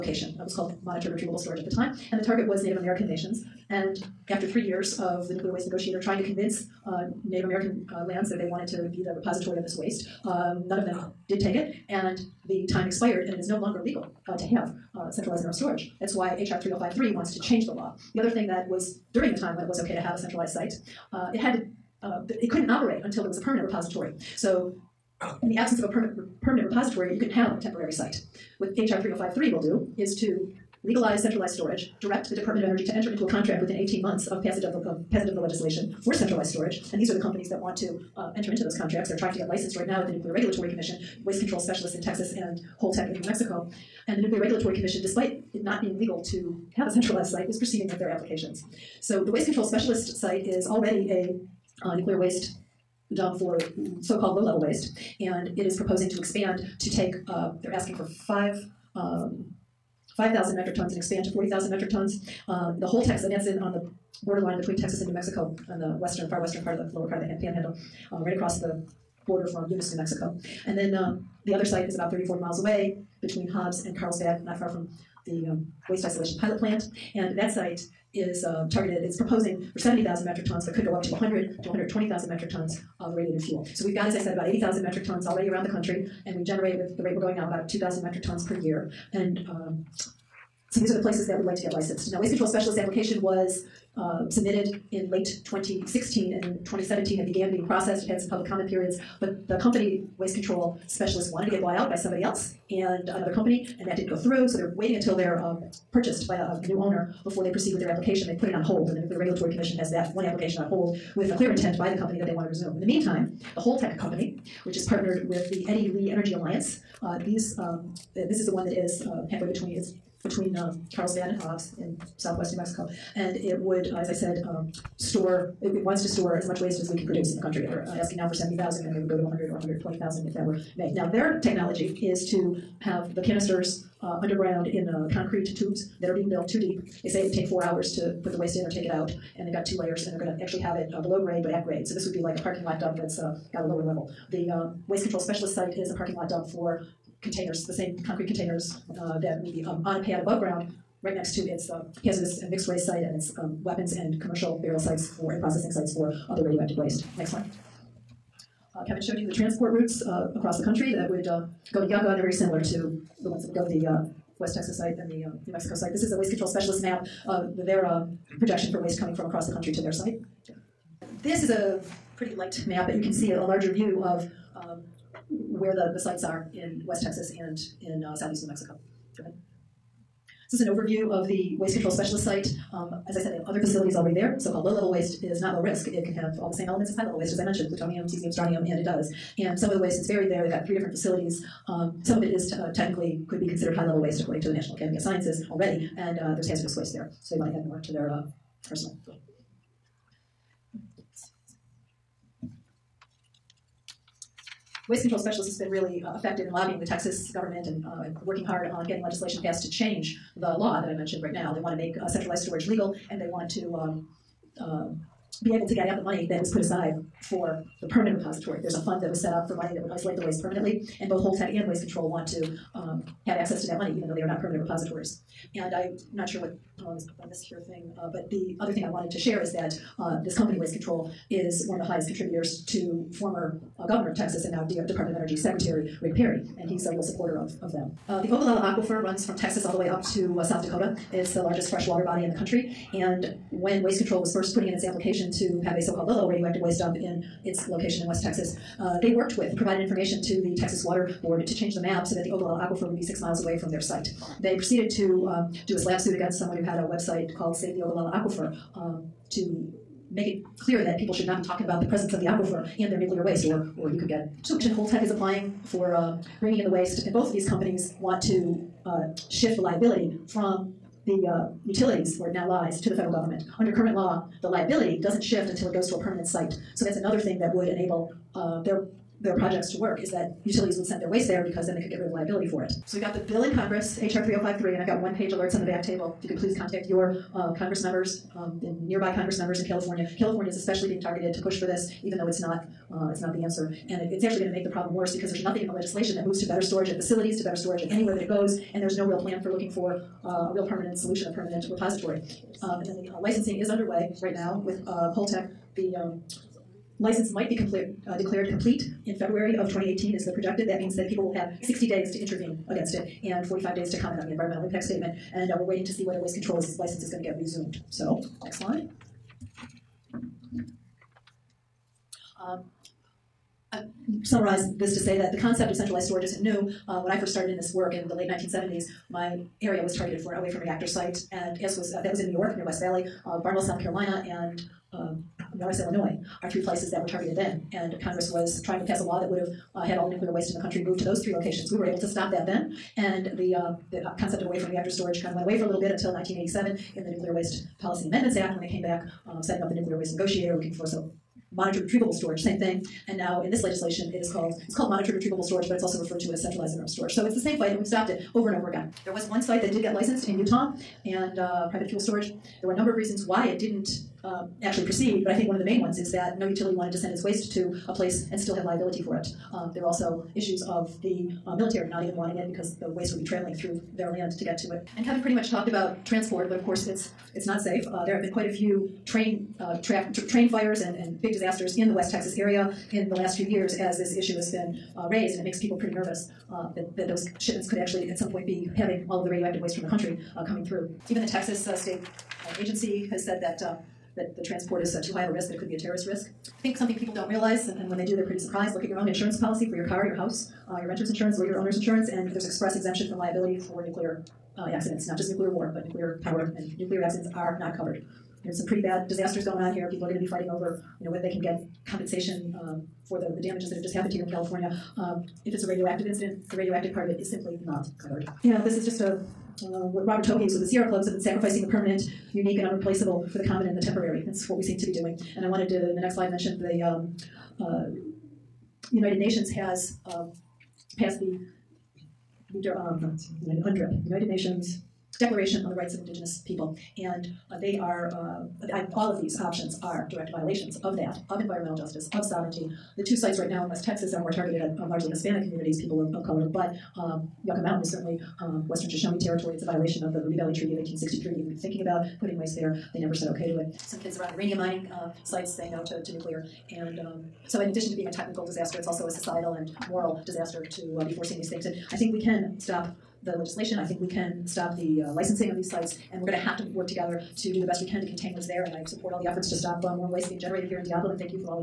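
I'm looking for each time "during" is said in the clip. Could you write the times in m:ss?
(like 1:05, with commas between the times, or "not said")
0:19.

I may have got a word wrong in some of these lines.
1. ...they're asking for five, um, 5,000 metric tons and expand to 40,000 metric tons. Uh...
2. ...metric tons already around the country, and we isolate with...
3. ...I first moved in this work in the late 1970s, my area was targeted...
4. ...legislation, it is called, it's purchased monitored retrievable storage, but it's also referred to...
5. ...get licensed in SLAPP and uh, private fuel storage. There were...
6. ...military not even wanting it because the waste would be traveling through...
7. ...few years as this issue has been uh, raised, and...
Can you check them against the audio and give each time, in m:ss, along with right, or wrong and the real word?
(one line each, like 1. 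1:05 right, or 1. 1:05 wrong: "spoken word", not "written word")
1. 0:57 right
2. 1:24 wrong: "generate", not "isolate"
3. 5:27 wrong: "started", not "moved"
4. 5:53 wrong: "called", not "purchased"
5. 5:59 wrong: "Utah", not "SLAPP"
6. 6:11 right
7. 6:23 right.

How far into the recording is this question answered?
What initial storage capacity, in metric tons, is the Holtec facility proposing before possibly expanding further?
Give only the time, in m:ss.
1:19.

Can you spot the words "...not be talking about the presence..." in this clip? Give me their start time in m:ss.
4:21.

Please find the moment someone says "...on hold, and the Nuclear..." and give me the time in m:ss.
1:48.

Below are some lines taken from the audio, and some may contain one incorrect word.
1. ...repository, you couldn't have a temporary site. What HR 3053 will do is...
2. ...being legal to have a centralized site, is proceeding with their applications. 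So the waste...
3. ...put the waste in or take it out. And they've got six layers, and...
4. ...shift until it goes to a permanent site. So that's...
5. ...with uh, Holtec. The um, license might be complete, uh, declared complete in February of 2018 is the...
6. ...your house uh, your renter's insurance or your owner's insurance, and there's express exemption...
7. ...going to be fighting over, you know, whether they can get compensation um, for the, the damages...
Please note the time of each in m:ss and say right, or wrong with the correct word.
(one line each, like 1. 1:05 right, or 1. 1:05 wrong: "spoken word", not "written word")
1. 0:26 right
2. 0:45 right
3. 2:18 wrong: "two", not "six"
4. 4:35 right
5. 5:04 right
6. 6:40 right
7. 6:50 right.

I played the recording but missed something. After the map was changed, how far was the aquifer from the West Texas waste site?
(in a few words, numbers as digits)
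6 miles.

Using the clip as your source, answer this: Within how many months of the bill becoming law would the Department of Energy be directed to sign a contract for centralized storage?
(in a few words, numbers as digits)
18.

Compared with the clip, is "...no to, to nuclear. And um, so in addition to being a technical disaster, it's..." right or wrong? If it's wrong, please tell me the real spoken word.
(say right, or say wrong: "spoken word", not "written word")
right.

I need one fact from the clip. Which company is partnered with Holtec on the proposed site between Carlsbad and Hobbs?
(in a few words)
Eddie Lee Energy Alliance.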